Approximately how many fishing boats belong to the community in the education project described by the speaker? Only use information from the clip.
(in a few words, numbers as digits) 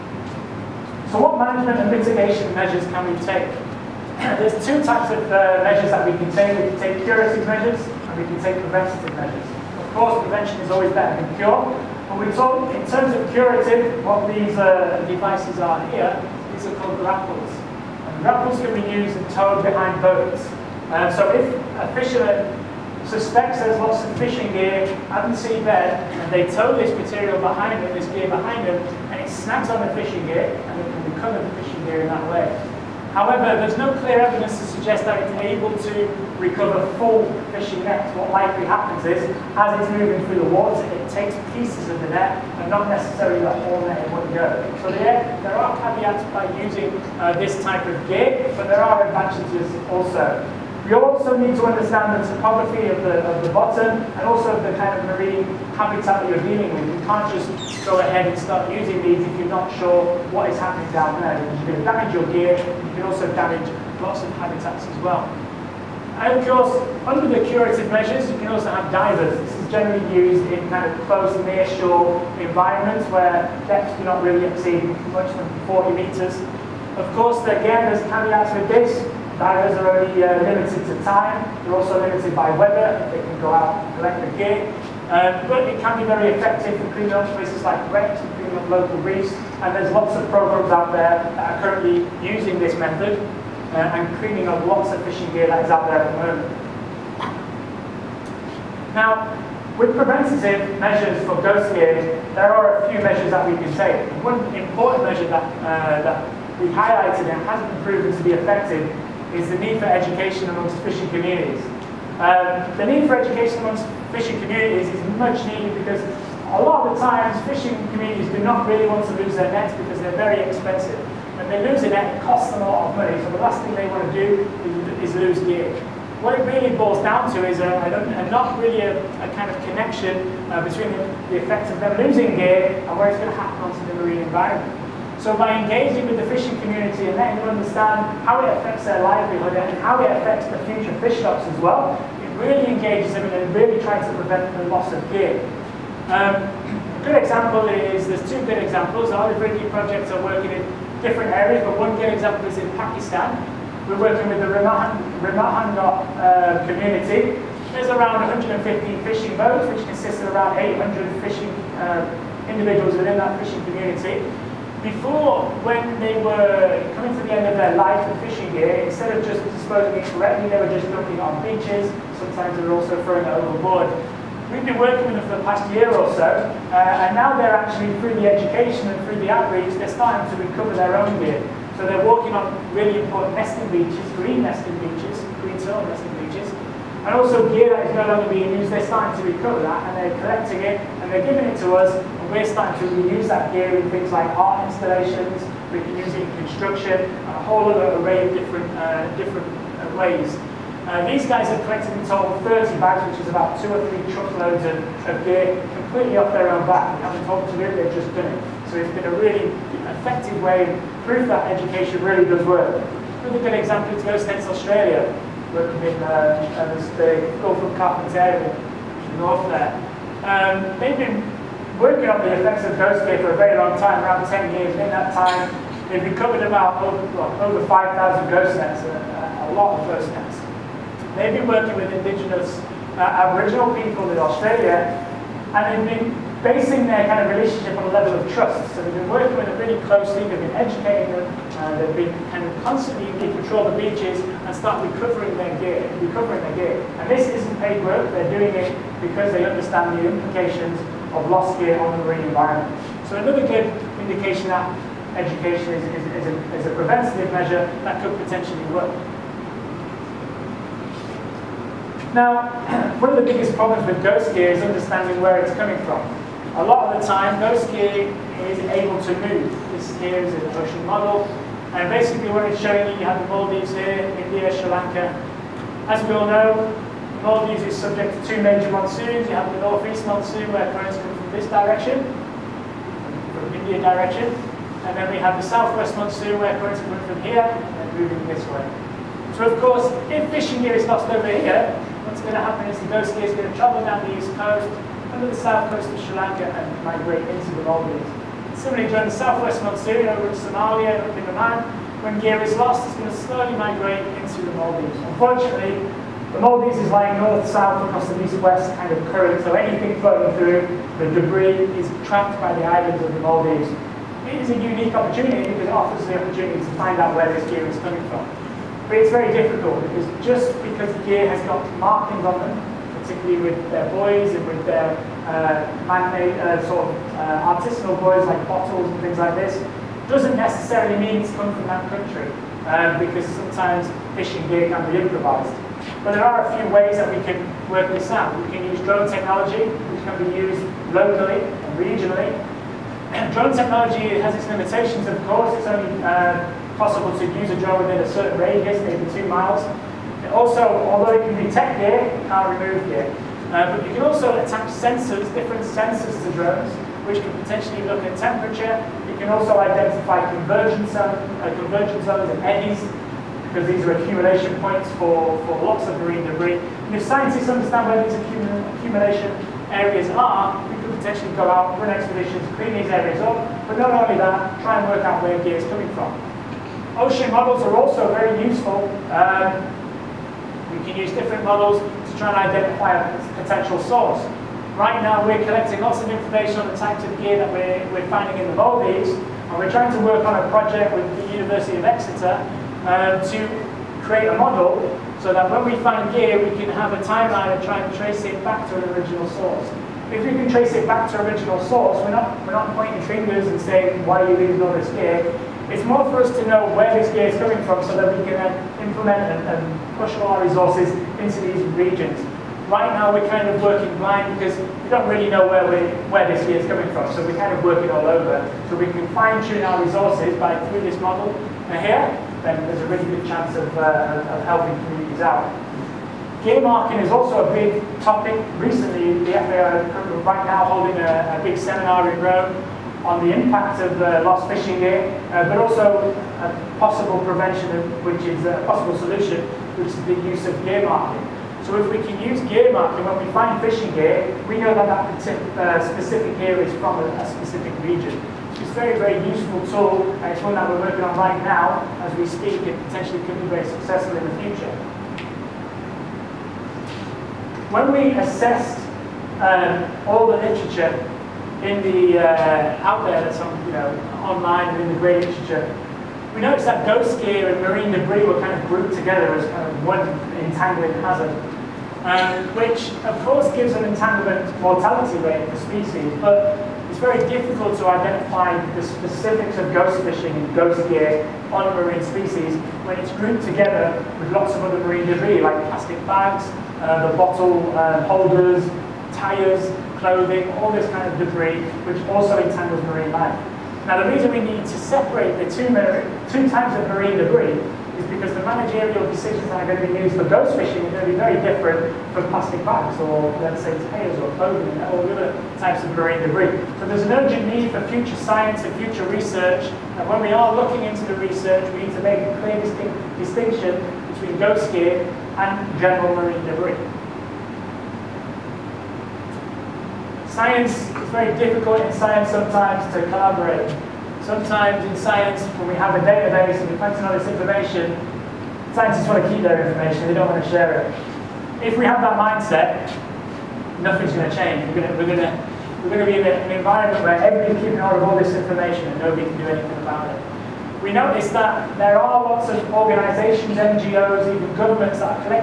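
150.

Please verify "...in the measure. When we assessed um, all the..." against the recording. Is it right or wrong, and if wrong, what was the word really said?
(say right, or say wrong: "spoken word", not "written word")
wrong: "future", not "measure".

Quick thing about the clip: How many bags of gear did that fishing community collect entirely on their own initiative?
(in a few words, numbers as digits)
30.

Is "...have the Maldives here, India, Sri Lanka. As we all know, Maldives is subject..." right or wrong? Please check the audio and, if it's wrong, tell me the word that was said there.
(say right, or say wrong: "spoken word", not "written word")
right.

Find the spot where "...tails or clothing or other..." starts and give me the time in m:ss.
8:23.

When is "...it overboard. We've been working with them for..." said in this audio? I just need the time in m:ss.
2:53.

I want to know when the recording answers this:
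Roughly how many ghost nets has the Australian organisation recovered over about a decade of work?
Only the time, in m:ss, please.
3:47.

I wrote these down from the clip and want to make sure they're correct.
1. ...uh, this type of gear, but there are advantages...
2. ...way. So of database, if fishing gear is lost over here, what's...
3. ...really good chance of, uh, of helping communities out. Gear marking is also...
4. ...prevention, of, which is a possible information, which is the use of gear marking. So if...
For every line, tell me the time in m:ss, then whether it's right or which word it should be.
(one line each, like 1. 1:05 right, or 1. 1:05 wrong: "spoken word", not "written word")
1. 0:47 right
2. 4:48 wrong: "course", not "database"
3. 7:02 right
4. 7:17 wrong: "solution", not "information".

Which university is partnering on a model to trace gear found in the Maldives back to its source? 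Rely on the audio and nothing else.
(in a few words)
University of Exeter.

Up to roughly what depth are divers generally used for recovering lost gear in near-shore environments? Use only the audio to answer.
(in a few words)
40 meters.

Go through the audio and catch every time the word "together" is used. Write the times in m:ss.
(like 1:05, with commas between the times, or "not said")
7:48, 8:03.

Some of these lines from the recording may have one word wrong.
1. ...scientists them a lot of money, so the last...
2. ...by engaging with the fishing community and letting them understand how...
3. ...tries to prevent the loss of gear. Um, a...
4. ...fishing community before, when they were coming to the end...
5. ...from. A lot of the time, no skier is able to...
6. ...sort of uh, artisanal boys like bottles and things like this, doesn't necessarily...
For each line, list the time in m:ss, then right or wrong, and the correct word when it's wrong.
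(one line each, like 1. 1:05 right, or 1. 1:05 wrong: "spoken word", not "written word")
1. 2:02 wrong: "costs", not "scientists"
2. 2:15 right
3. 2:23 right
4. 2:43 right
5. 4:25 right
6. 5:26 right.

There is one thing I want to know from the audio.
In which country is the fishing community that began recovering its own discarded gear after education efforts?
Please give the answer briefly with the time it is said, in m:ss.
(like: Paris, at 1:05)
Pakistan, at 2:32.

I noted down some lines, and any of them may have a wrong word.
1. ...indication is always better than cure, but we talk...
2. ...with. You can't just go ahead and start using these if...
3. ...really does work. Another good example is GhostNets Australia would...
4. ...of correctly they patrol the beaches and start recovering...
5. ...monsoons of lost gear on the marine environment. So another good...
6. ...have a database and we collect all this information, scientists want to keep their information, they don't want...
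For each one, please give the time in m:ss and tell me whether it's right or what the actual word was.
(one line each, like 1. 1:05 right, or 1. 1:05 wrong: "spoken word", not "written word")
1. 0:10 wrong: "prevention", not "indication"
2. 0:56 right
3. 3:32 right
4. 4:02 wrong: "constantly", not "correctly"
5. 4:10 wrong: "implications", not "monsoons"
6. 8:45 right.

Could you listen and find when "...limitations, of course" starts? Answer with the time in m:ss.
5:44.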